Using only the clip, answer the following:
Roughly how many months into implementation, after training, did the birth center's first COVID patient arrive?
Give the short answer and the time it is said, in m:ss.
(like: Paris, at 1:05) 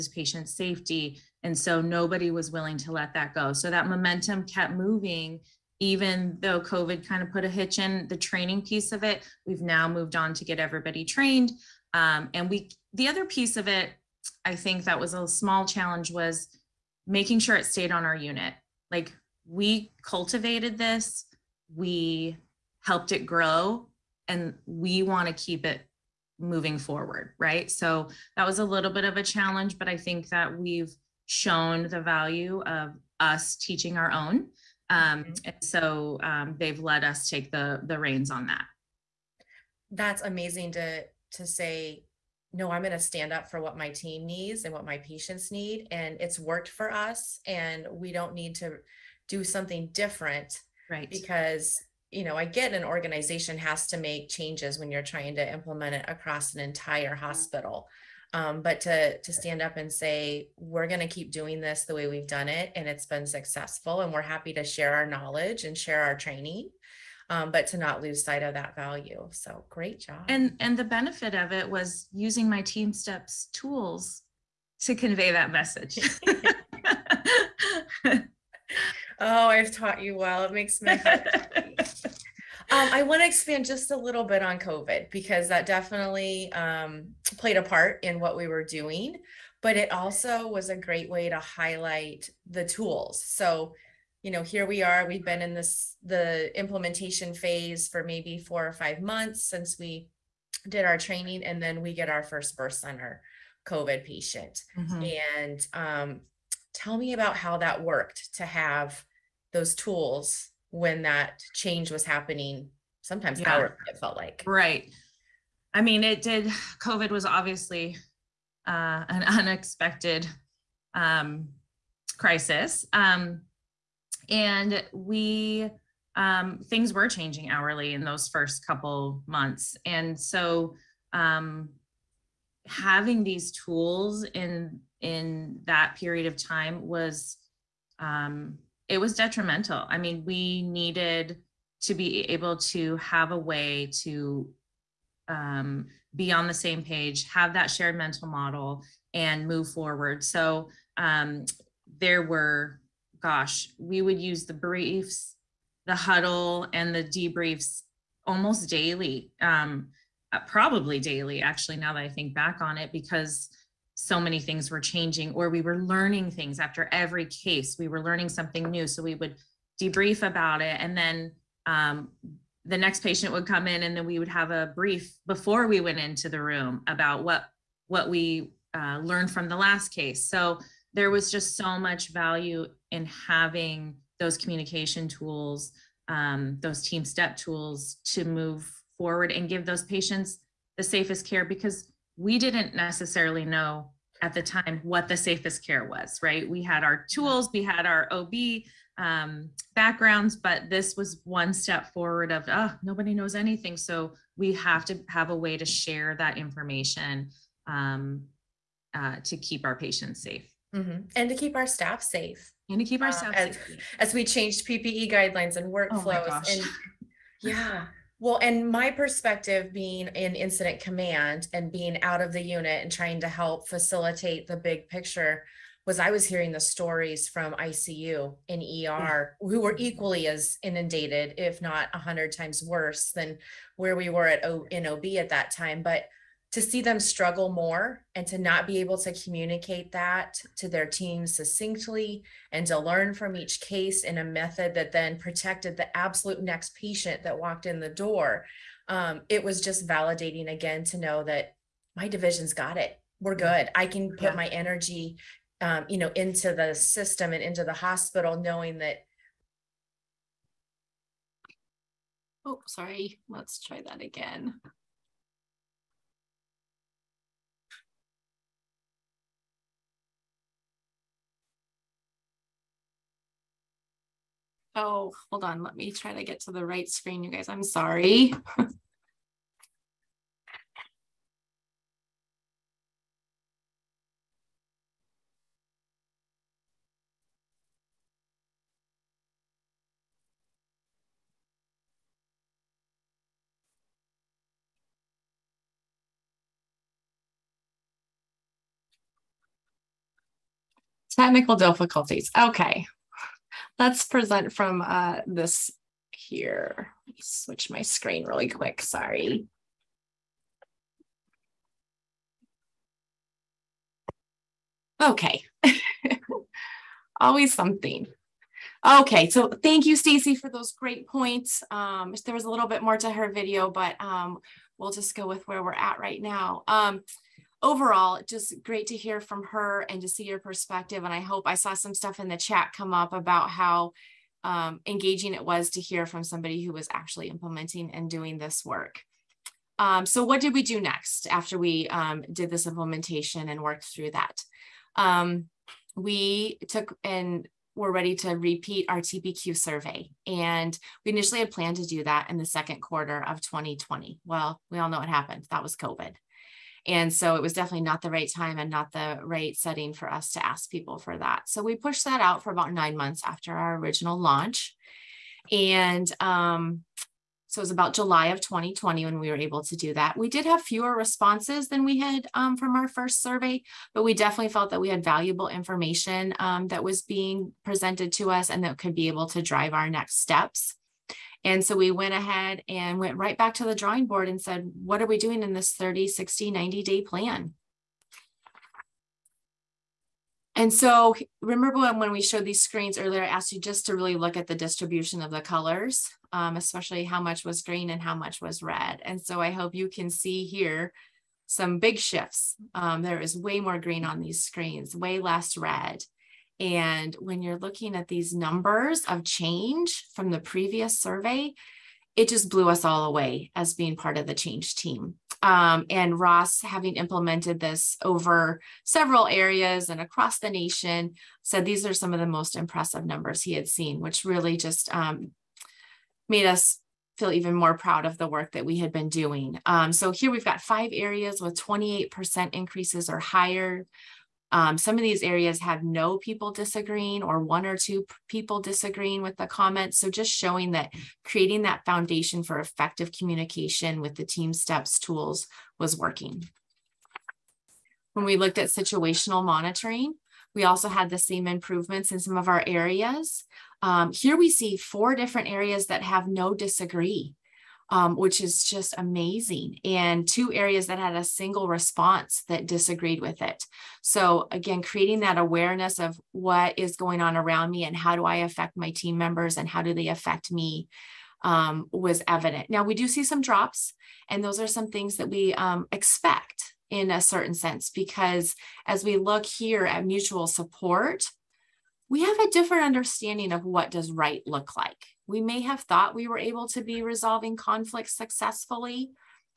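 4 or 5 months, at 1:38.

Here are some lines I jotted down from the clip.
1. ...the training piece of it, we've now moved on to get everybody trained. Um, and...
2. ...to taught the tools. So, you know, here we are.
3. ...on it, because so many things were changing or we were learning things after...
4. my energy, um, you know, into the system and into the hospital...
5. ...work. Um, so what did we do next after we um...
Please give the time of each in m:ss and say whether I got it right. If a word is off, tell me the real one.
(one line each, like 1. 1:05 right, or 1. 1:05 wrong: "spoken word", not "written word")
1. 0:08 right
2. 1:31 wrong: "highlight", not "taught"
3. 2:42 right
4. 4:14 right
5. 5:38 right.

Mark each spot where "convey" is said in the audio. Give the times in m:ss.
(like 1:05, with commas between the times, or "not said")
1:14.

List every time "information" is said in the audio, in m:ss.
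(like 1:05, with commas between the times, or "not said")
3:26, 6:15.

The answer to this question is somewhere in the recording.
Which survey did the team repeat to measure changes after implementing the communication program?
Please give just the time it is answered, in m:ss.
5:48.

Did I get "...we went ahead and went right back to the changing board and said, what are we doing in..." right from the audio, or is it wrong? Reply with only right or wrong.
wrong.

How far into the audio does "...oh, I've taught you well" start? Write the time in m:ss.
1:18.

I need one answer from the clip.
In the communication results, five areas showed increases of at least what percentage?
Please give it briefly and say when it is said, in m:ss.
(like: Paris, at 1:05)
28%, at 7:11.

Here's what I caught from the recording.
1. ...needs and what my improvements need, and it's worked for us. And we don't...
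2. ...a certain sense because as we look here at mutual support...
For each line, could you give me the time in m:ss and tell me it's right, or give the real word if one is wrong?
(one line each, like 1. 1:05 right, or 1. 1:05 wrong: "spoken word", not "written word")
1. 0:44 wrong: "patients", not "improvements"
2. 7:57 right.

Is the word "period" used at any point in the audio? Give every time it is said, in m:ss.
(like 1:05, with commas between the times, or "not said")
2:15.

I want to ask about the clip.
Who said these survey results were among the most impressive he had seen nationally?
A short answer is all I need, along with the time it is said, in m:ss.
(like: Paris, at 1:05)
Ross, at 6:56.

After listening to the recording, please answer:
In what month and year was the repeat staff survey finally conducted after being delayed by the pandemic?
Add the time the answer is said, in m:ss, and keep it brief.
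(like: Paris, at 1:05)
July 2020, at 6:07.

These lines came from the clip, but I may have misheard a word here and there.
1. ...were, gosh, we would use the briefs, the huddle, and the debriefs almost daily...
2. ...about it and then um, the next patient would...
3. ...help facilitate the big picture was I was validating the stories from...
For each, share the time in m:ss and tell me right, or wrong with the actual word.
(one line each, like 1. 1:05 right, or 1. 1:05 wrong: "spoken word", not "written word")
1. 2:32 right
2. 2:50 right
3. 3:43 wrong: "hearing", not "validating".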